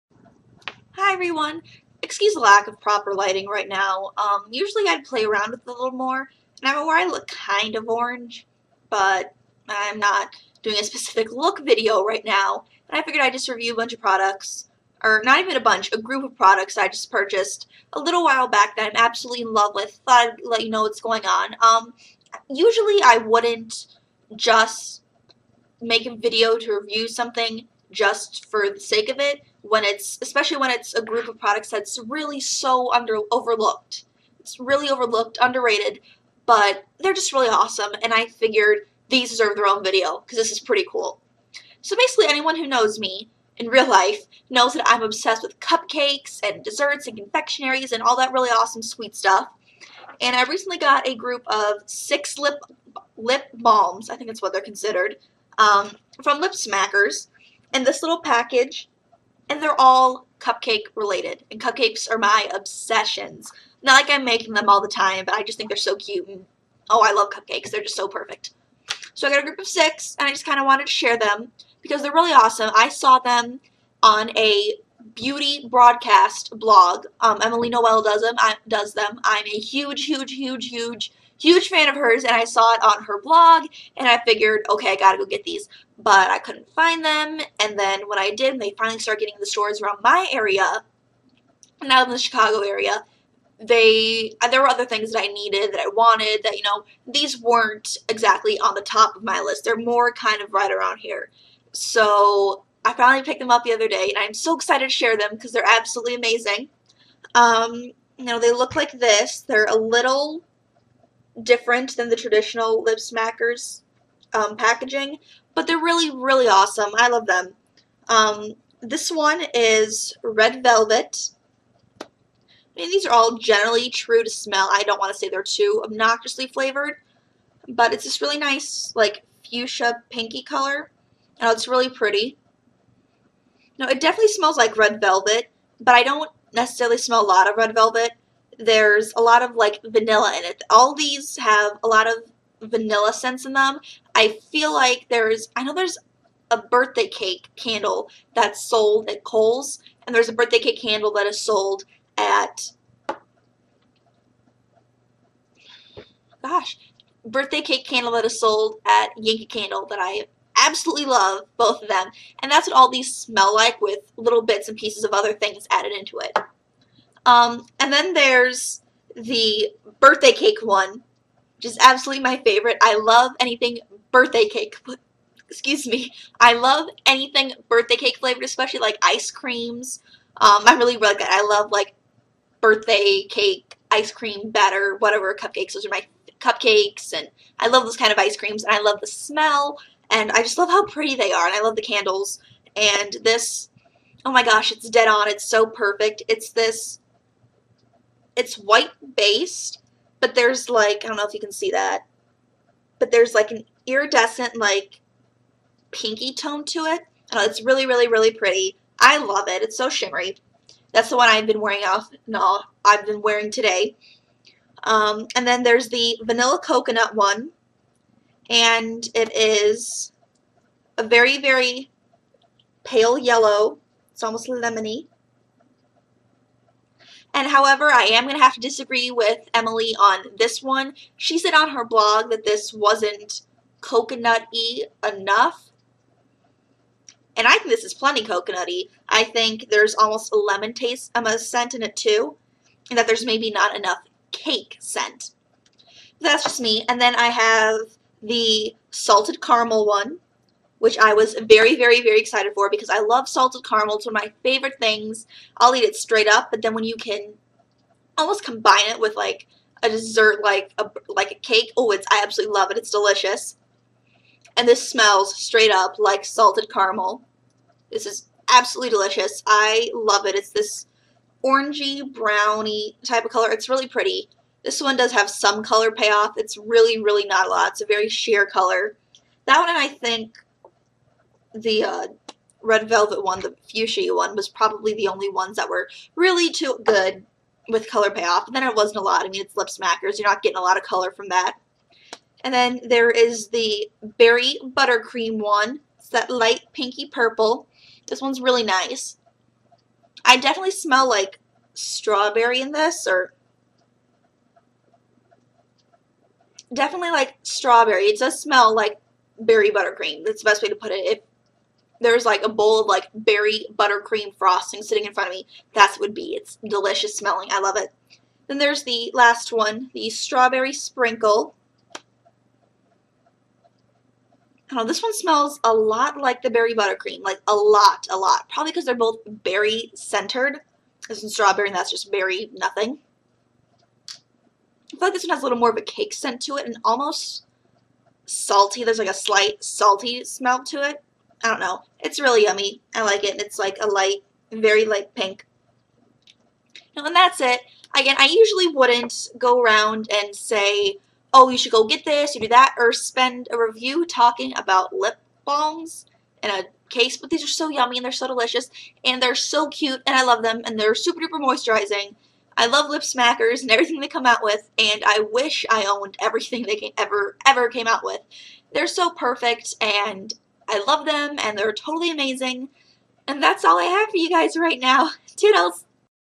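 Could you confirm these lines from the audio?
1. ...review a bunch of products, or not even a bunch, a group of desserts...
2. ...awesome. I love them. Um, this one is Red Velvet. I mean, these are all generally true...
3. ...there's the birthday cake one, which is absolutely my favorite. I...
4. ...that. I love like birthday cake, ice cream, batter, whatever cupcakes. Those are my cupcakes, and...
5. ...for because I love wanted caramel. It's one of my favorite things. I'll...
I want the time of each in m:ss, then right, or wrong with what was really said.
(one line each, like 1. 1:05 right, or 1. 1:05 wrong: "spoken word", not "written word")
1. 0:13 wrong: "products", not "desserts"
2. 1:56 right
3. 2:48 right
4. 3:01 right
5. 4:12 wrong: "salted", not "wanted".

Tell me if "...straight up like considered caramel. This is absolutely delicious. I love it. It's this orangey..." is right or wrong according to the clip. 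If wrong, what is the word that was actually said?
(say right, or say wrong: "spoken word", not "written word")
wrong: "salted", not "considered".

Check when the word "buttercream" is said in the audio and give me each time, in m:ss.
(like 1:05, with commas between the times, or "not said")
4:54, 5:09, 5:13, 5:26.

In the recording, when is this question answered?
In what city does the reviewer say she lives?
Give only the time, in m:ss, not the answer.
1:32.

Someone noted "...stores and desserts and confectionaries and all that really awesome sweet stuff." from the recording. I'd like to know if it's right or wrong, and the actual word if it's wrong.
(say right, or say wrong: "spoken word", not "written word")
wrong: "cupcakes", not "stores".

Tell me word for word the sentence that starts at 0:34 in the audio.
It's really overlooked, underrated, but they're just really awesome and I figured these deserve their own video because this is pretty cool.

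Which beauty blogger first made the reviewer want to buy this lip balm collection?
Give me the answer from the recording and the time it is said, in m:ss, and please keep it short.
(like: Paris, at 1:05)
Emily Noel, at 1:17.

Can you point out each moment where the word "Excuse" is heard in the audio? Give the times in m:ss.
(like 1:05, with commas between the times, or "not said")
0:02, 2:55.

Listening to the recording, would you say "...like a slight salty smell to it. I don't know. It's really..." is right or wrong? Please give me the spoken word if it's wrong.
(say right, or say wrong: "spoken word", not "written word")
right.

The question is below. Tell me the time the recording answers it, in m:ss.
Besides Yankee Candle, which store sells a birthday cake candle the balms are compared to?
2:29.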